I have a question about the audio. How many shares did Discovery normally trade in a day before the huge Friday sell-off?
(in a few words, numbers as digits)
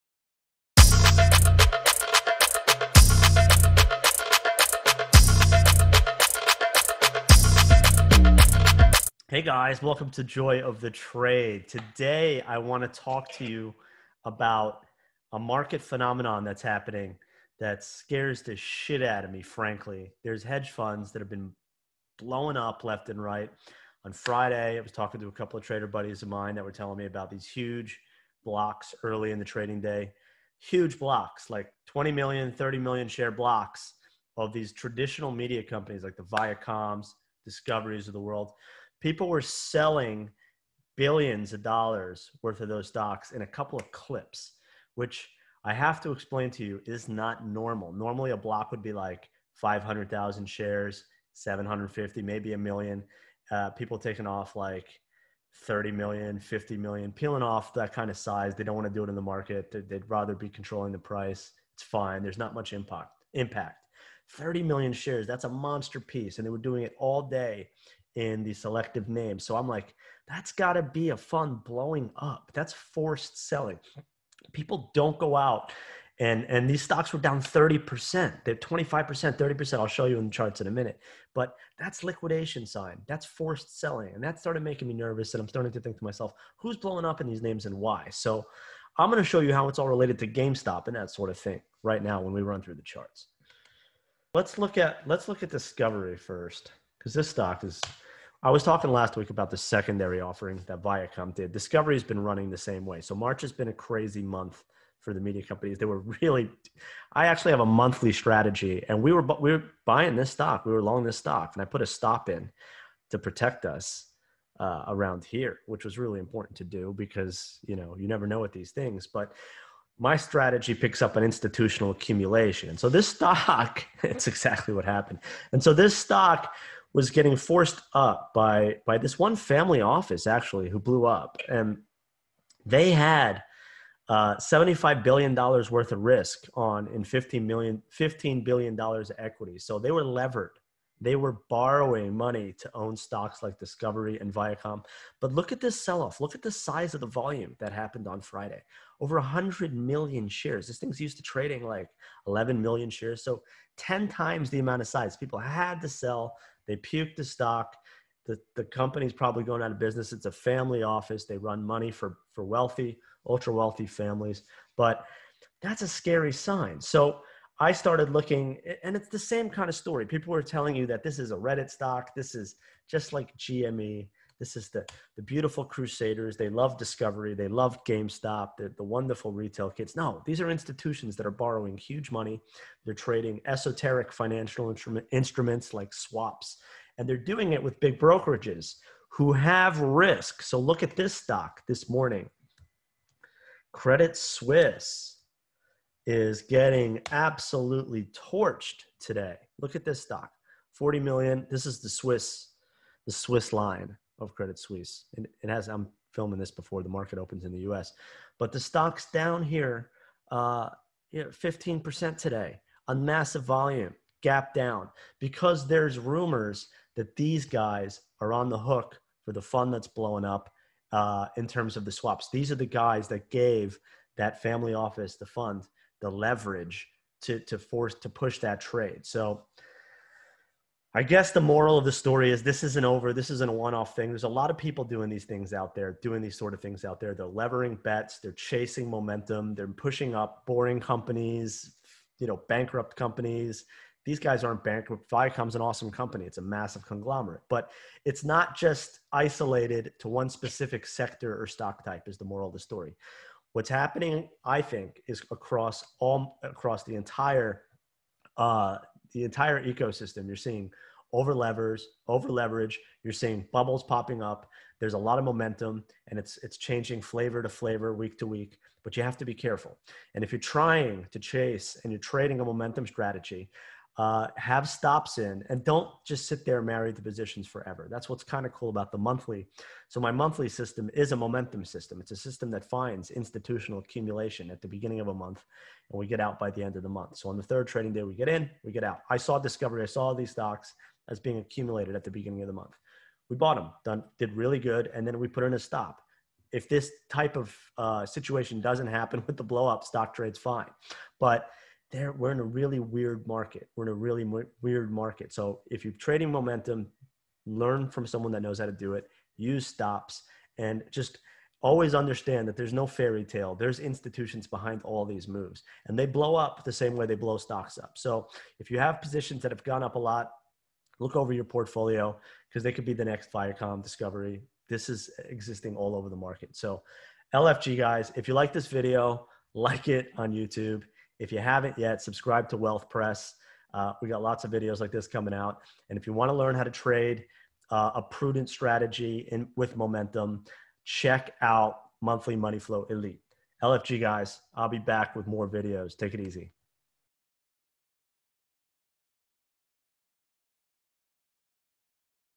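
11 million.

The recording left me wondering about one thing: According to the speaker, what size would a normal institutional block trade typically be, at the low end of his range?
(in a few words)
500,000 shares.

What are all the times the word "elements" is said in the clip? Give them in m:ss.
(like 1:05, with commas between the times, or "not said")
not said.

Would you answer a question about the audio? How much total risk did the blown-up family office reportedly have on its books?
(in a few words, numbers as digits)
$75 billion.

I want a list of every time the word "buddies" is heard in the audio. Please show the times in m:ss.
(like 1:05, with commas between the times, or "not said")
0:25.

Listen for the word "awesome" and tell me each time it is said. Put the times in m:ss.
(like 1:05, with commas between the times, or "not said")
4:05.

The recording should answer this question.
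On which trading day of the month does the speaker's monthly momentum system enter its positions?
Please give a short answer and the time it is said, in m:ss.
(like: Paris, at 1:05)
Third trading day, at 4:47.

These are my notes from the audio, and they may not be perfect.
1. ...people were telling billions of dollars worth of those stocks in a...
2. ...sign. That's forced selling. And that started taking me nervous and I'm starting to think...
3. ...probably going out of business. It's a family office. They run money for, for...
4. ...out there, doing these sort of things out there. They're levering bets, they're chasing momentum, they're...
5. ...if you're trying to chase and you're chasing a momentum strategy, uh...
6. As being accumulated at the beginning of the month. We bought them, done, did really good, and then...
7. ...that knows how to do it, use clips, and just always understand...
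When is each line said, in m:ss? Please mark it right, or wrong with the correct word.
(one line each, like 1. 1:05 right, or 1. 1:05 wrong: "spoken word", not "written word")
1. 0:39 wrong: "selling", not "telling"
2. 1:22 wrong: "making", not "taking"
3. 2:39 right
4. 3:55 right
5. 4:30 wrong: "trading", not "chasing"
6. 4:51 right
7. 5:08 wrong: "stops", not "clips".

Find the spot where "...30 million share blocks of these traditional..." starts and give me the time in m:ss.
0:32.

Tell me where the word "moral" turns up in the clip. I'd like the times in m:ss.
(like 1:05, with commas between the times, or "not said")
3:51, 4:12.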